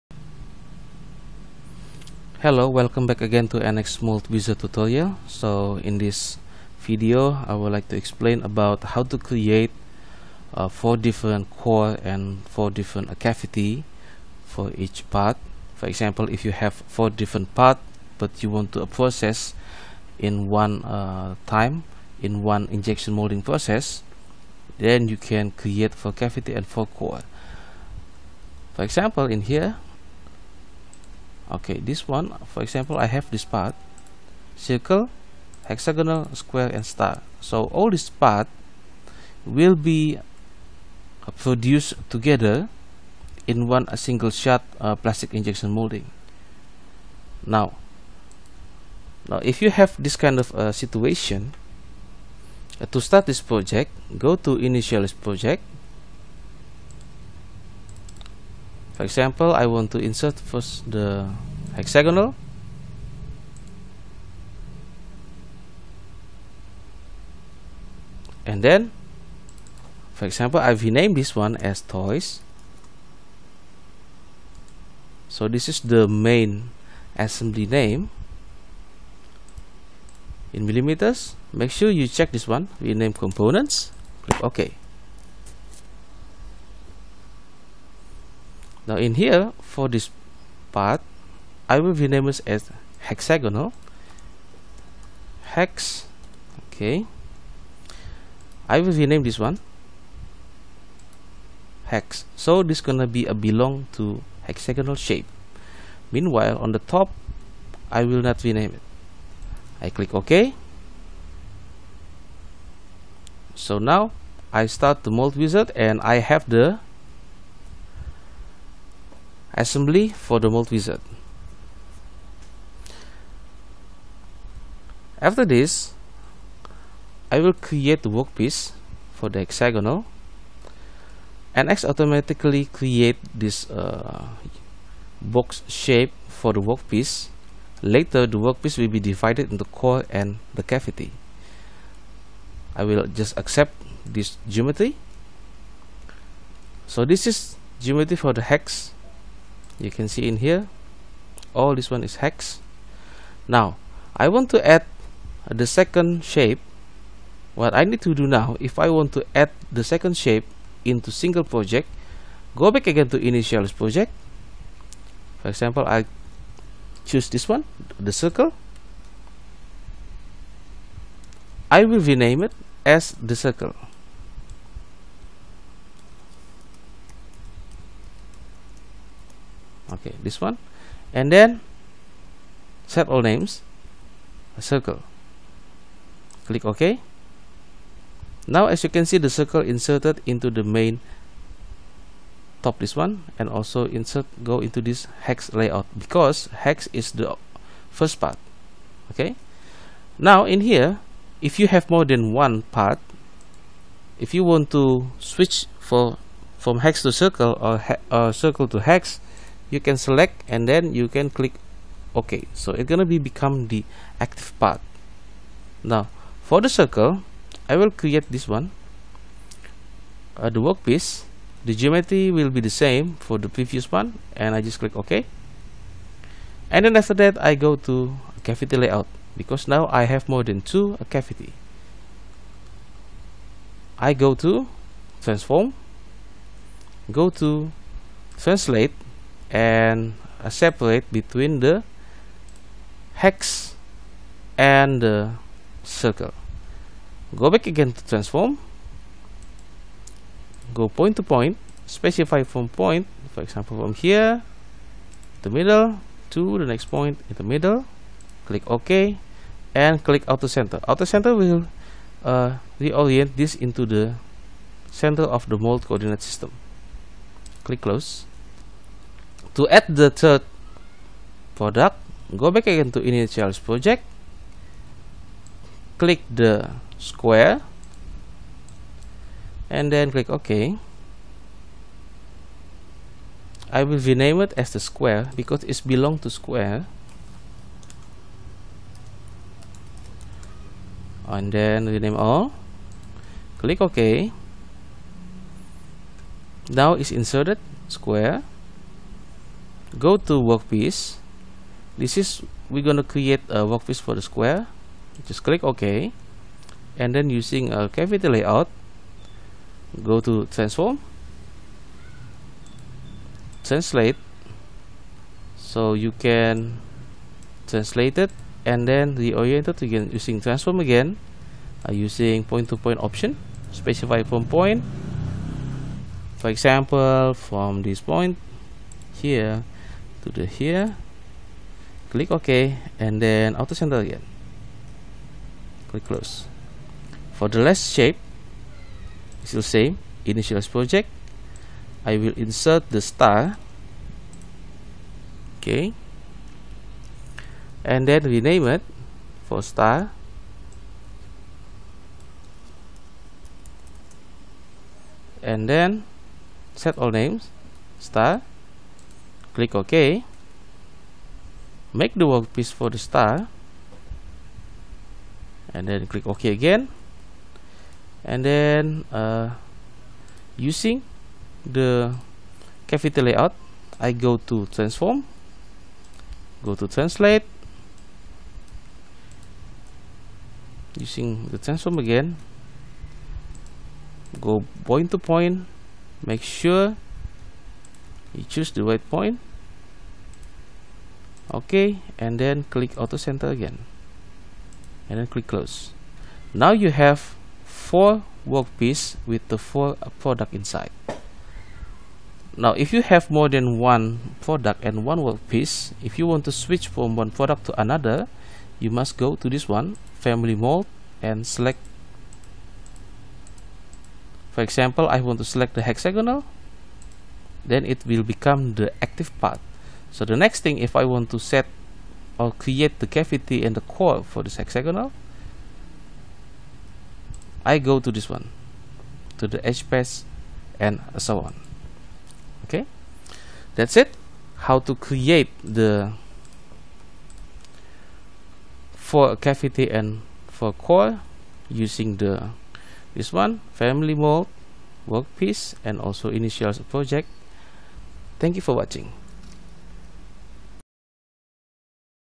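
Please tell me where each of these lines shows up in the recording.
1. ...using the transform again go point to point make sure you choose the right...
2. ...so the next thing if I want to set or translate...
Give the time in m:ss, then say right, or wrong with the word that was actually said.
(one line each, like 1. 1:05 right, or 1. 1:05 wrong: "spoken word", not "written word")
1. 6:20 right
2. 7:00 wrong: "create", not "translate".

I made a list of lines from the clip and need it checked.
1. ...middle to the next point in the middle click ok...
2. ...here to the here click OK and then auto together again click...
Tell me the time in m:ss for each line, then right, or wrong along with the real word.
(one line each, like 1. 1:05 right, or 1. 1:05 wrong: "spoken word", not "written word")
1. 4:15 right
2. 5:29 wrong: "center", not "together".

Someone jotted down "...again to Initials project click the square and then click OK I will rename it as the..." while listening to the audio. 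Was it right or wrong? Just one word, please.
right.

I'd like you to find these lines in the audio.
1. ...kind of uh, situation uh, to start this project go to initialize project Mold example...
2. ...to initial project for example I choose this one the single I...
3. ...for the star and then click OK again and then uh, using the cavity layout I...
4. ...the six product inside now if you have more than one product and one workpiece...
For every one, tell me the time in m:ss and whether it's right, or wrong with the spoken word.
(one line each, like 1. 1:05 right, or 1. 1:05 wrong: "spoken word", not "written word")
1. 0:50 wrong: "For", not "Mold"
2. 2:43 wrong: "circle", not "single"
3. 6:02 right
4. 6:39 wrong: "four", not "six".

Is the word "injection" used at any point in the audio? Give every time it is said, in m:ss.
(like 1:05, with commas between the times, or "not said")
0:22, 0:45.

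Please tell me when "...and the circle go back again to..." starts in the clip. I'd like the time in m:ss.
4:04.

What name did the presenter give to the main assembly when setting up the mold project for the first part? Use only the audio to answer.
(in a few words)
toys.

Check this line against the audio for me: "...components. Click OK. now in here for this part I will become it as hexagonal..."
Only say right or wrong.
wrong.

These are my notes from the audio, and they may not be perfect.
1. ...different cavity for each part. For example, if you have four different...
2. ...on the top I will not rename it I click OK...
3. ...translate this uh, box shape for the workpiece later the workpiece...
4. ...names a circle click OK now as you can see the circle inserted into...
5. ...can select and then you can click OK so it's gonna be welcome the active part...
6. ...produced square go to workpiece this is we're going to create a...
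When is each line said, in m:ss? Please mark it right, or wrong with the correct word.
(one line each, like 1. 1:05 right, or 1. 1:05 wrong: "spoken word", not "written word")
1. 0:12 right
2. 1:46 right
3. 2:12 wrong: "create", not "translate"
4. 3:03 right
5. 3:29 wrong: "become", not "welcome"
6. 4:57 wrong: "inserted", not "produced".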